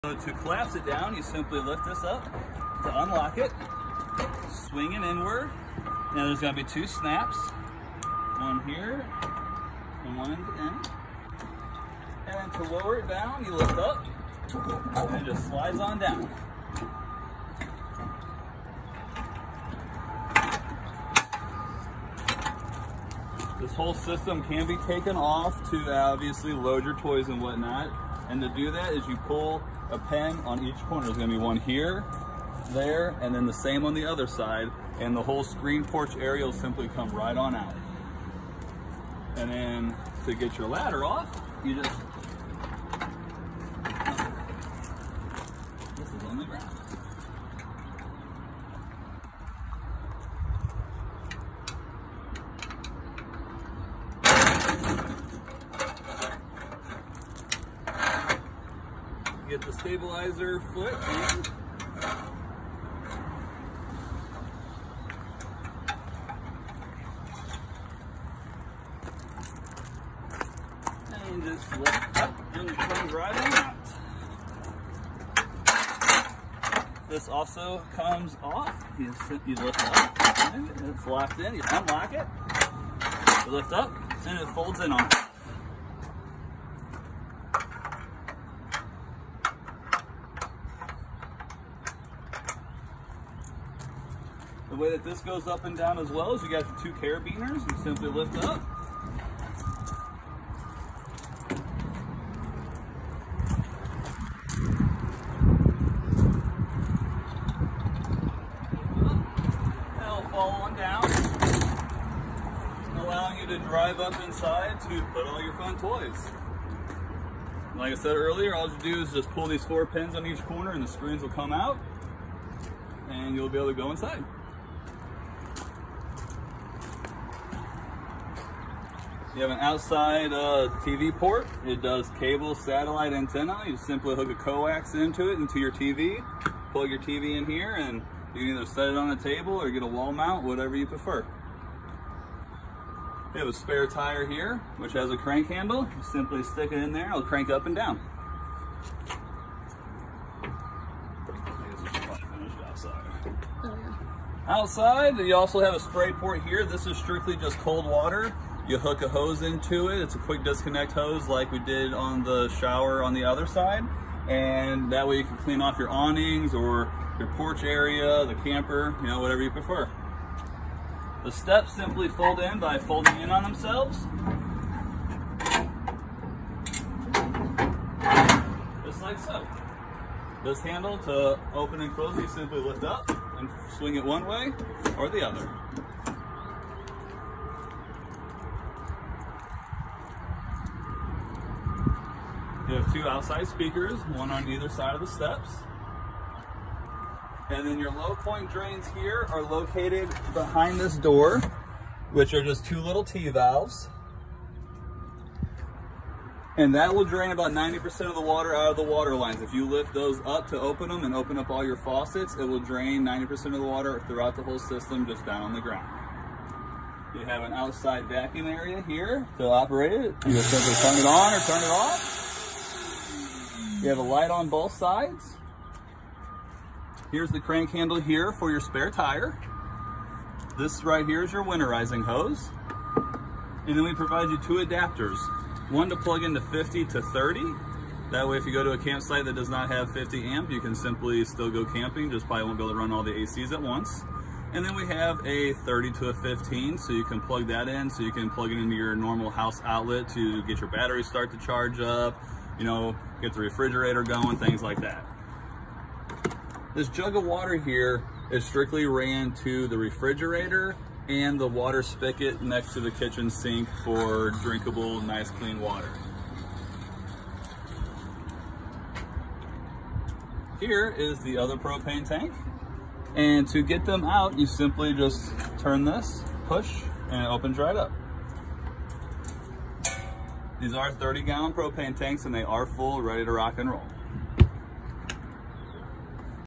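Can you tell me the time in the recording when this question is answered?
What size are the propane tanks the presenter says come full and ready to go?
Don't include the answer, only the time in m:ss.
4:40.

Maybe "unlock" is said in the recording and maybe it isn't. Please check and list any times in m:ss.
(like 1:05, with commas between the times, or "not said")
0:03, 1:21.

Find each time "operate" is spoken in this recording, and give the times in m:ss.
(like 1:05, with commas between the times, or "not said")
3:39.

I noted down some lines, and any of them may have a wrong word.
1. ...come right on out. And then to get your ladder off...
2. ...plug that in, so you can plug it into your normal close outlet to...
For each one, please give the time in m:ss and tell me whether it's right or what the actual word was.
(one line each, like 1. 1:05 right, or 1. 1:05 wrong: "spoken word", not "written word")
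1. 0:36 right
2. 4:07 wrong: "house", not "close".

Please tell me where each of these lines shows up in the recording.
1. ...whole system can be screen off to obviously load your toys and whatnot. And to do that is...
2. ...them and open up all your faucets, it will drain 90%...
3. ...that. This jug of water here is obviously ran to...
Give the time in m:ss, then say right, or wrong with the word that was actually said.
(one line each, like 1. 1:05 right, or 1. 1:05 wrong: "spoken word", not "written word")
1. 0:23 wrong: "taken", not "screen"
2. 3:30 right
3. 4:14 wrong: "strictly", not "obviously".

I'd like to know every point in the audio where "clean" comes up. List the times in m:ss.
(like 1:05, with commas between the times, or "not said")
2:45, 4:25.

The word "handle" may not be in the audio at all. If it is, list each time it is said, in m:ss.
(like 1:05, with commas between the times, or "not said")
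2:25, 3:00, 3:47.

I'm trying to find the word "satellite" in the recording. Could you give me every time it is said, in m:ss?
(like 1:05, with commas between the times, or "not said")
2:12.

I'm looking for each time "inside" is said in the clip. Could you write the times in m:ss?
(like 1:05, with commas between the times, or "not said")
1:54, 2:03.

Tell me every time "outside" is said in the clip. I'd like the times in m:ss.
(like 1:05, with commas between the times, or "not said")
2:09, 2:34, 3:13, 3:37.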